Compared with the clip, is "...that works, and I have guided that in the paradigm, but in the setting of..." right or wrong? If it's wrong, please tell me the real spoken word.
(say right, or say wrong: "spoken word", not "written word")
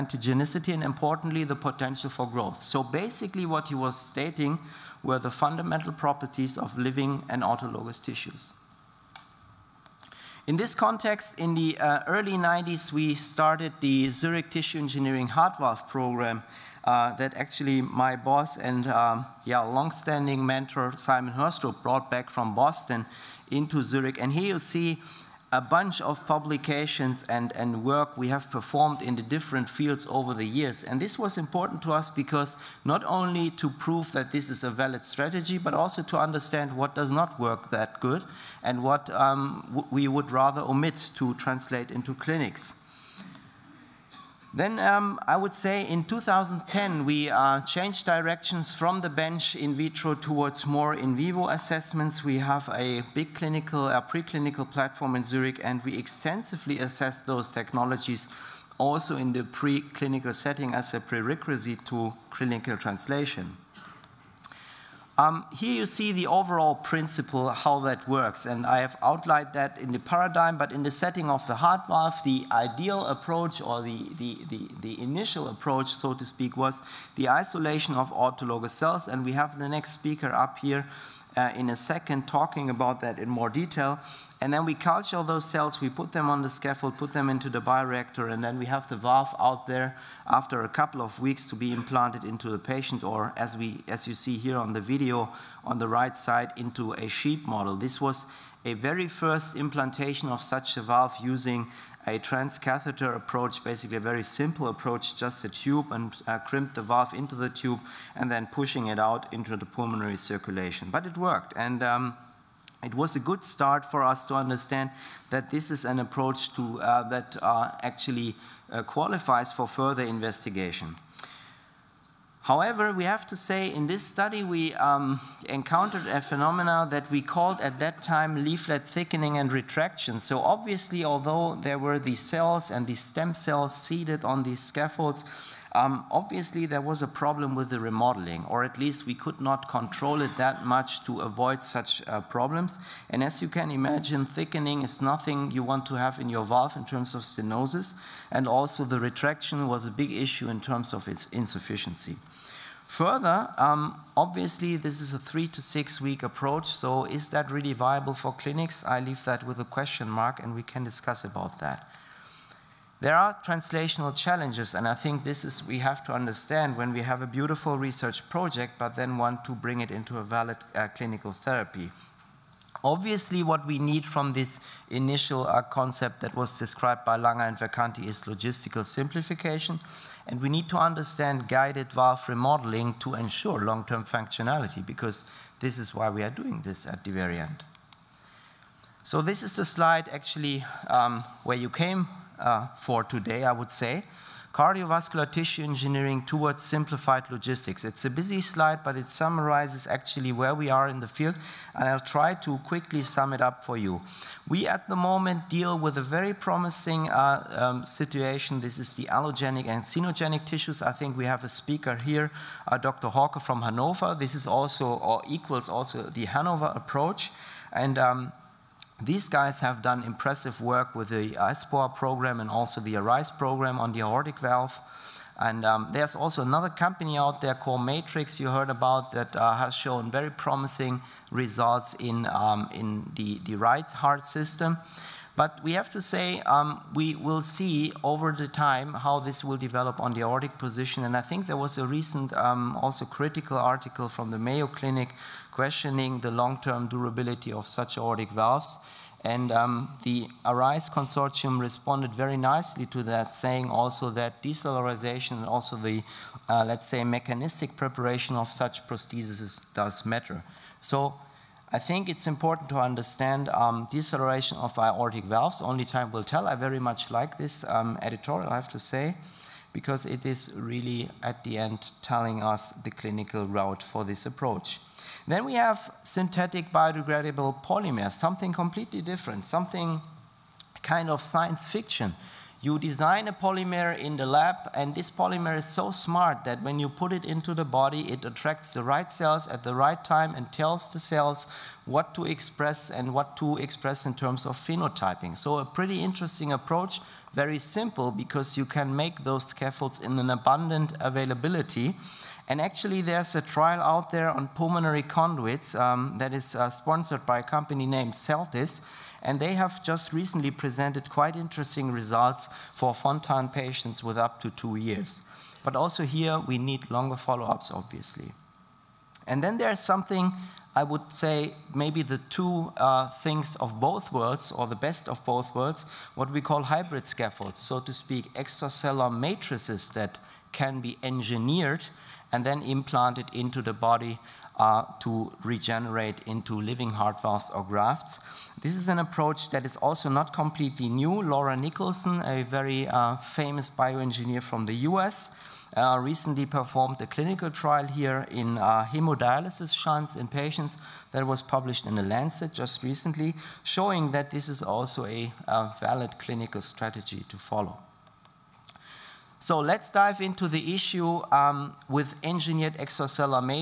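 wrong: "outlined", not "guided".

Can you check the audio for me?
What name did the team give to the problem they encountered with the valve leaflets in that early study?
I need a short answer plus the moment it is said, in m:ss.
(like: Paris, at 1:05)
Leaflet thickening and retraction, at 2:08.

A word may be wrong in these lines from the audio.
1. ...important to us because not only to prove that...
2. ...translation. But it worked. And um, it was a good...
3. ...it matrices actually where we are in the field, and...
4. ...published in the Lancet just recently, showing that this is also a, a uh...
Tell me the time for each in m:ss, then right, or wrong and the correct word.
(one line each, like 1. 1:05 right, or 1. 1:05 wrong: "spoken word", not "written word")
1. 0:31 right
2. 1:50 wrong: "circulation", not "translation"
3. 3:18 wrong: "summarizes", not "matrices"
4. 5:51 right.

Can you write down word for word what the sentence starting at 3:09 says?
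So this is the slide actually um, where you came uh, for today, I would say.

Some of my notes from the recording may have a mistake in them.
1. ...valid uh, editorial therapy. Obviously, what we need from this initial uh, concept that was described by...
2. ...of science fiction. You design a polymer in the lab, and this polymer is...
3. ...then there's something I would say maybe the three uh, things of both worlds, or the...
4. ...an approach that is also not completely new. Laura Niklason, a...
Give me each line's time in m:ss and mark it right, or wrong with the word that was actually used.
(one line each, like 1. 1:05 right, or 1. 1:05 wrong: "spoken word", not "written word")
1. 2:50 wrong: "clinical", not "editorial"
2. 4:41 right
3. 5:19 wrong: "two", not "three"
4. 5:38 right.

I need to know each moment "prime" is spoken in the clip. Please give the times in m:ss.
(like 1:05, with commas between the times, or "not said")
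not said.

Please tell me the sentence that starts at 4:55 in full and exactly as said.
So a pretty interesting approach, very simple, because you can make those scaffolds in an abundant availability.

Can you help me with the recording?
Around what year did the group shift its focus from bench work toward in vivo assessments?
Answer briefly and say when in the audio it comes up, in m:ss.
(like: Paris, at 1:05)
2010, at 0:46.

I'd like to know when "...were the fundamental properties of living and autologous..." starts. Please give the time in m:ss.
0:05.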